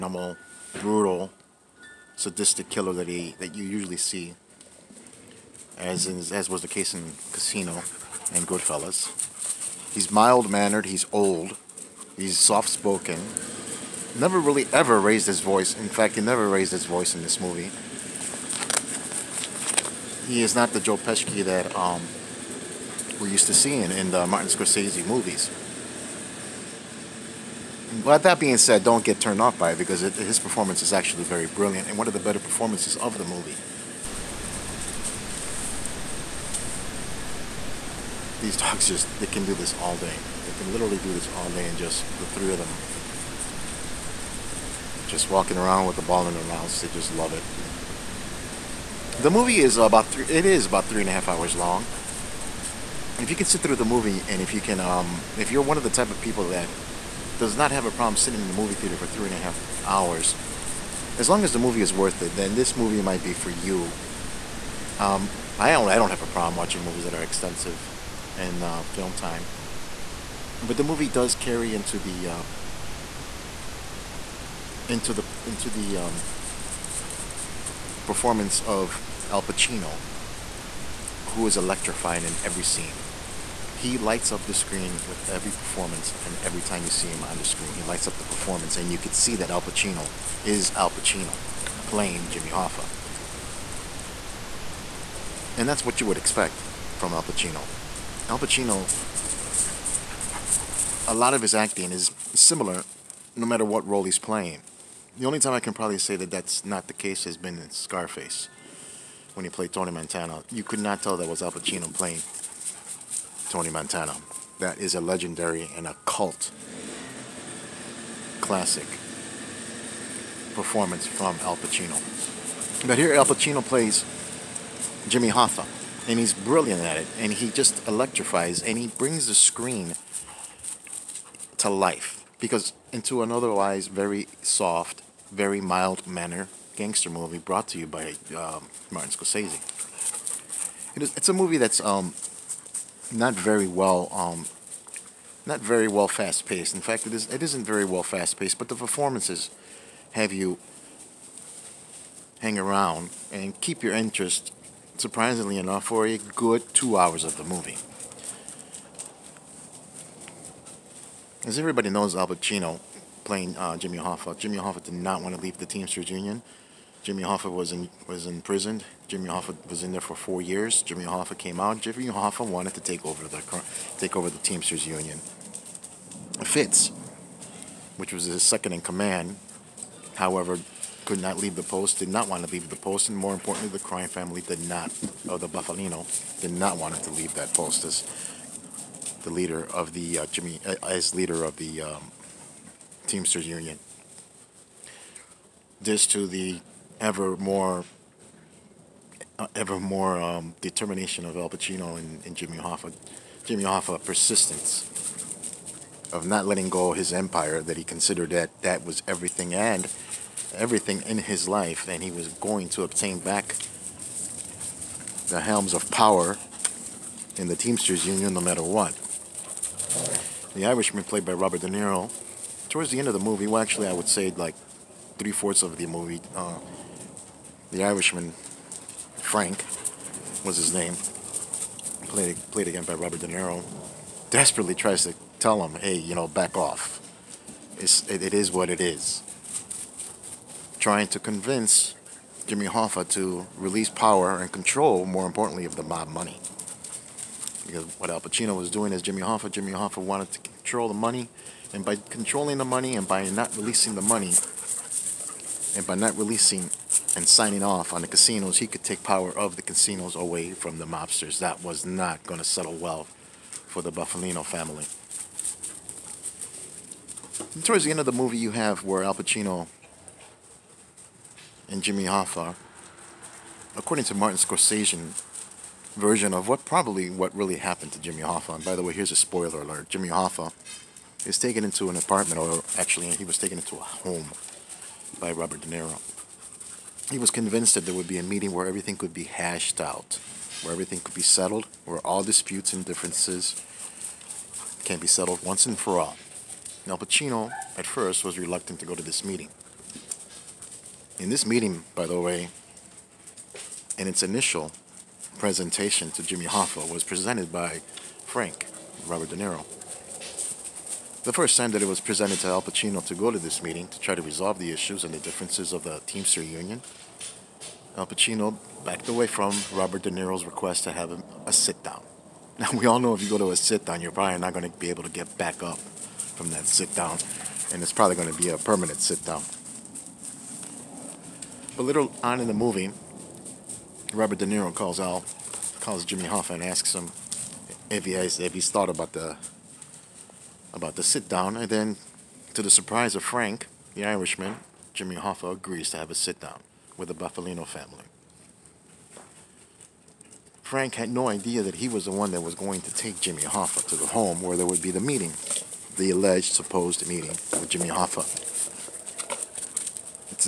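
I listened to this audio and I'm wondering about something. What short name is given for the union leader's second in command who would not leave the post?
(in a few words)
Fitz.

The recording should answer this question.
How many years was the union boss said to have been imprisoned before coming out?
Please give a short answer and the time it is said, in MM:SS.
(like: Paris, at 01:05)
4, at 02:50.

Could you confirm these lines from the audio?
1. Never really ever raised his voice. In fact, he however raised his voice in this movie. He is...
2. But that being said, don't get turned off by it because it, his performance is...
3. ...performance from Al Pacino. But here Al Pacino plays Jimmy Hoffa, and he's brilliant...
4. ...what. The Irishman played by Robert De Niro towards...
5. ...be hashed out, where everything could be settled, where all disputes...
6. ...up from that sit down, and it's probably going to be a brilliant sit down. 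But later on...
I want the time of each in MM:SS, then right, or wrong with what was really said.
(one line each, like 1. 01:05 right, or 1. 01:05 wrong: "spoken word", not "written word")
1. 00:14 wrong: "never", not "however"
2. 00:28 right
3. 02:00 right
4. 03:38 right
5. 04:49 right
6. 05:25 wrong: "permanent", not "brilliant".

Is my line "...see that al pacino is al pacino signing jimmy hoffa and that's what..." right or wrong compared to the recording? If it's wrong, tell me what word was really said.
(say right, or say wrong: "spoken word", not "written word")
wrong: "playing", not "signing".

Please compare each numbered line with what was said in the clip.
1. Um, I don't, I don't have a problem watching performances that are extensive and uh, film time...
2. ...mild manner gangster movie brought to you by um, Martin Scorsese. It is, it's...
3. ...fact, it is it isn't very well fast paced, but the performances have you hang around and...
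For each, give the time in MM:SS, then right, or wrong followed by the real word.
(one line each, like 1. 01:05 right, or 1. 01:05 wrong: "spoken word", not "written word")
1. 01:05 wrong: "movies", not "performances"
2. 02:15 right
3. 02:26 right.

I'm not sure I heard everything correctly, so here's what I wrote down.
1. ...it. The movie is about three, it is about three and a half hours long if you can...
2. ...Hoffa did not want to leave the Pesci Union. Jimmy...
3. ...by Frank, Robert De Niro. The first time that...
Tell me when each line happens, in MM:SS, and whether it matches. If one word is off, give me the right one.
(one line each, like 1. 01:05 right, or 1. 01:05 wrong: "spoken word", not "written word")
1. 00:47 right
2. 02:44 wrong: "Teamsters", not "Pesci"
3. 05:07 right.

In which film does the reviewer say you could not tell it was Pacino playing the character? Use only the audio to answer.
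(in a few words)
Scarface.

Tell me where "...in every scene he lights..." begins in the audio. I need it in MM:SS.
01:22.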